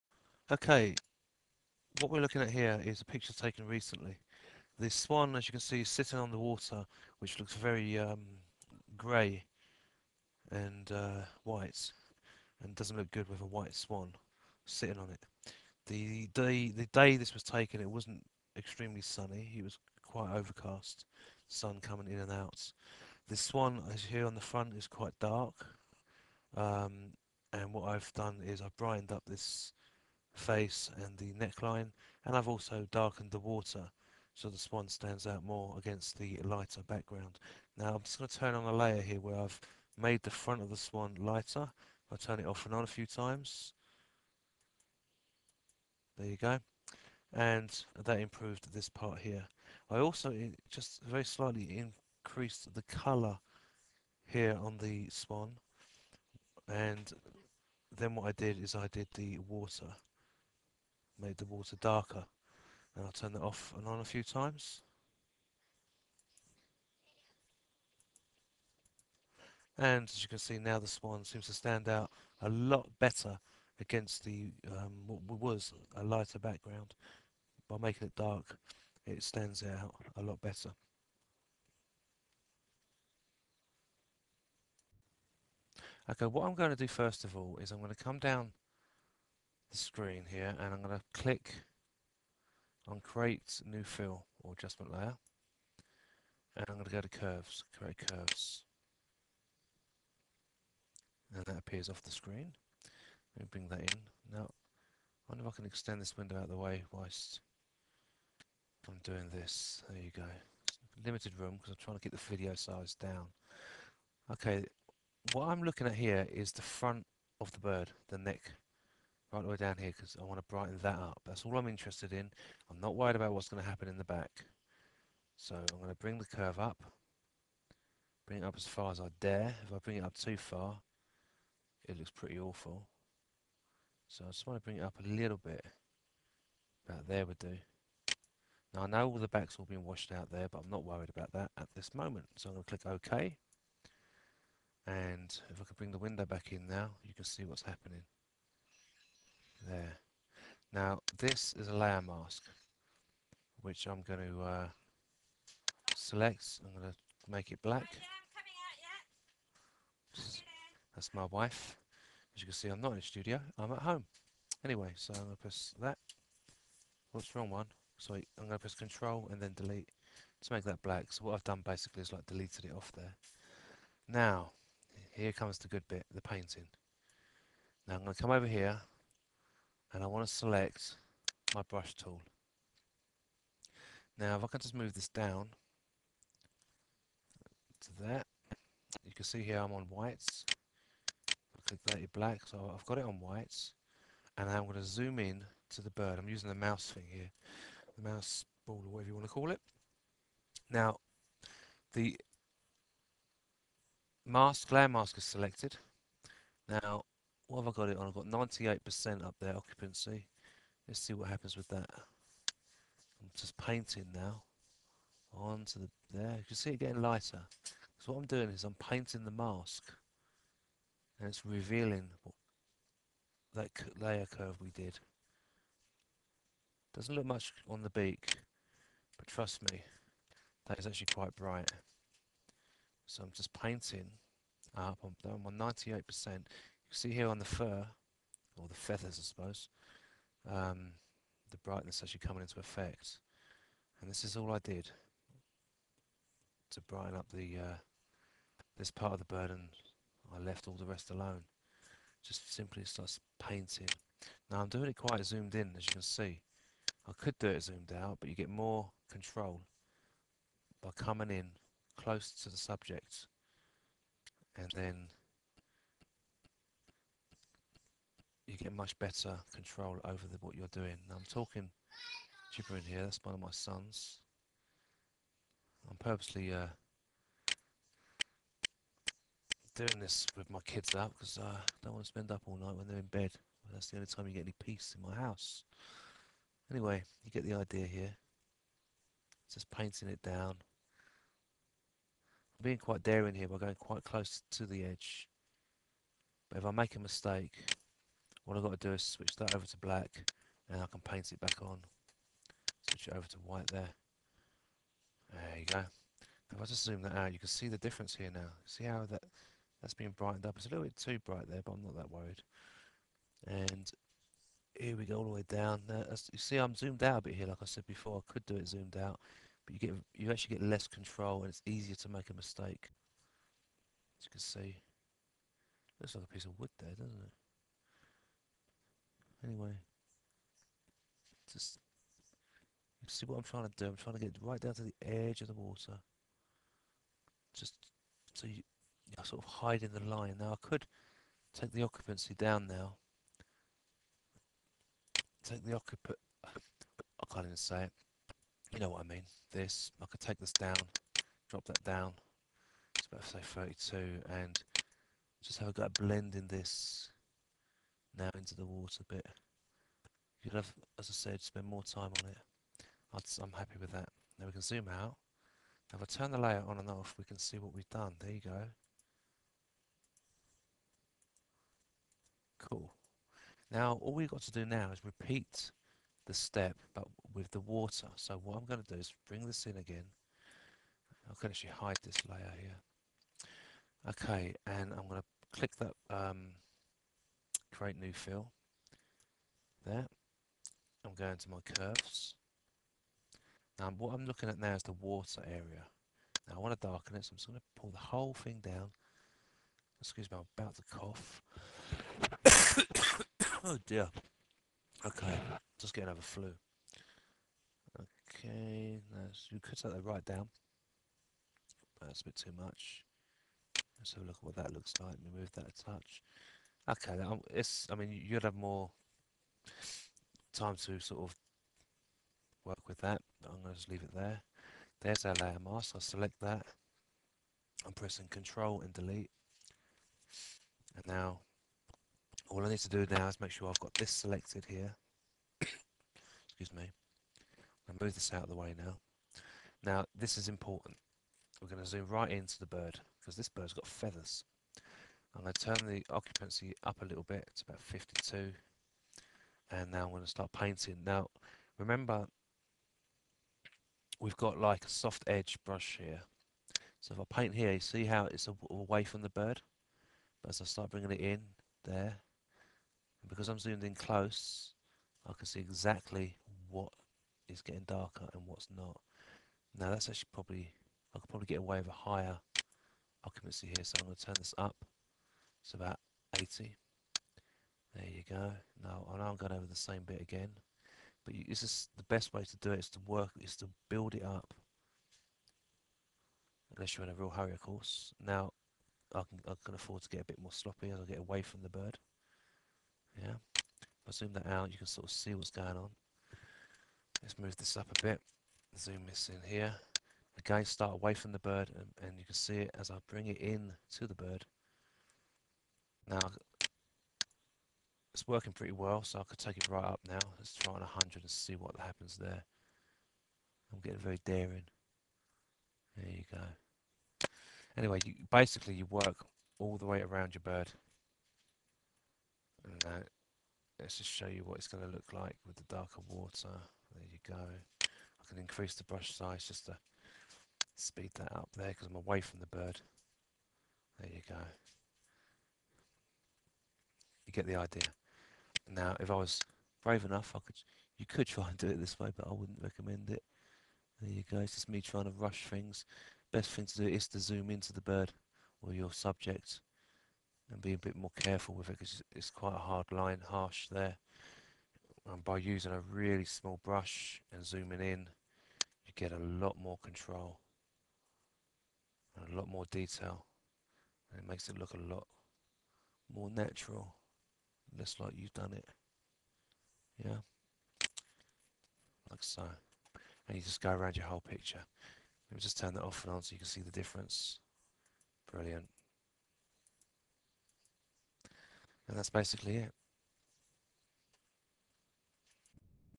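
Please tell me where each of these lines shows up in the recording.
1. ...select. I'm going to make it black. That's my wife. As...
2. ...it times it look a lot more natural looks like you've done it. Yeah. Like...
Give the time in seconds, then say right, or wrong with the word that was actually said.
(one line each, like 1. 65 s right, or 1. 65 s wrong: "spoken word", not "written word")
1. 155 s right
2. 564 s wrong: "makes", not "times".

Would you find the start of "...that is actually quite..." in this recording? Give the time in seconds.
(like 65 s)
230 s.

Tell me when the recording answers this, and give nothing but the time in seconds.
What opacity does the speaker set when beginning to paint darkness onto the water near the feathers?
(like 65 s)
447 s.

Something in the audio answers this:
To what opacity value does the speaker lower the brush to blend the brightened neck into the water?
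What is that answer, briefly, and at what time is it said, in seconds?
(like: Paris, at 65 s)
32, at 353 s.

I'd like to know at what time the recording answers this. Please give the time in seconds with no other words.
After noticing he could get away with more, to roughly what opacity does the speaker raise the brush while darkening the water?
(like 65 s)
476 s.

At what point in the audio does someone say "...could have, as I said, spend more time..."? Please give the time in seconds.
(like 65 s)
360 s.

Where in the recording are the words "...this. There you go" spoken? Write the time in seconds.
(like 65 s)
109 s.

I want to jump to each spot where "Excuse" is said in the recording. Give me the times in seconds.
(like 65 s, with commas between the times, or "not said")
399 s, 435 s.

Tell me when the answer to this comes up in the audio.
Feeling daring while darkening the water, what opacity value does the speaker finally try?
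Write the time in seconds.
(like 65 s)
510 s.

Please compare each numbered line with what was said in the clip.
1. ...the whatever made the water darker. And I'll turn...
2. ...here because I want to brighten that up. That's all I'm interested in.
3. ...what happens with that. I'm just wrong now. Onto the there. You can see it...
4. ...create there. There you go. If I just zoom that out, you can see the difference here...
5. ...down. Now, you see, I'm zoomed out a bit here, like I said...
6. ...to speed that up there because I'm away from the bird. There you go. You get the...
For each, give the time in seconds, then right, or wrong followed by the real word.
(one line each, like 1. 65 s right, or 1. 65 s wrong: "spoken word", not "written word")
1. 59 s wrong: "water", not "whatever"
2. 119 s right
3. 211 s wrong: "painting", not "wrong"
4. 303 s wrong: "white", not "create"
5. 315 s right
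6. 529 s right.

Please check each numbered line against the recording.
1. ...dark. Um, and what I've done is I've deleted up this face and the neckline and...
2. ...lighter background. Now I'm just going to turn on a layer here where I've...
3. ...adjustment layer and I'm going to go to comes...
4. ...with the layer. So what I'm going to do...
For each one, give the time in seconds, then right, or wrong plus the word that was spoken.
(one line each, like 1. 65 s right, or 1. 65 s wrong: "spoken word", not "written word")
1. 25 s wrong: "brightened", not "deleted"
2. 36 s right
3. 94 s wrong: "curves", not "comes"
4. 377 s wrong: "water", not "layer".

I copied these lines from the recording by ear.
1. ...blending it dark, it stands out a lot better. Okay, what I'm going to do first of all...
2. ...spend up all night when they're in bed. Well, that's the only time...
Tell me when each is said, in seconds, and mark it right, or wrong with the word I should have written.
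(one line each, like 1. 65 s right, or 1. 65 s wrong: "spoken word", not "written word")
1. 77 s wrong: "making", not "blending"
2. 282 s right.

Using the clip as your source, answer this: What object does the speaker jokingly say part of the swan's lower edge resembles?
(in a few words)
A piece of wood.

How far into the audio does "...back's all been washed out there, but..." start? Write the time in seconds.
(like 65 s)
139 s.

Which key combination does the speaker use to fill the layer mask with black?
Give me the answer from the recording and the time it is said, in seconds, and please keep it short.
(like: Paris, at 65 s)
Control and Delete, at 168 s.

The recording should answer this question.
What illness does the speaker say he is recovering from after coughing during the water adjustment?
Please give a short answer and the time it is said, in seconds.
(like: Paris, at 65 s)
Flu, at 406 s.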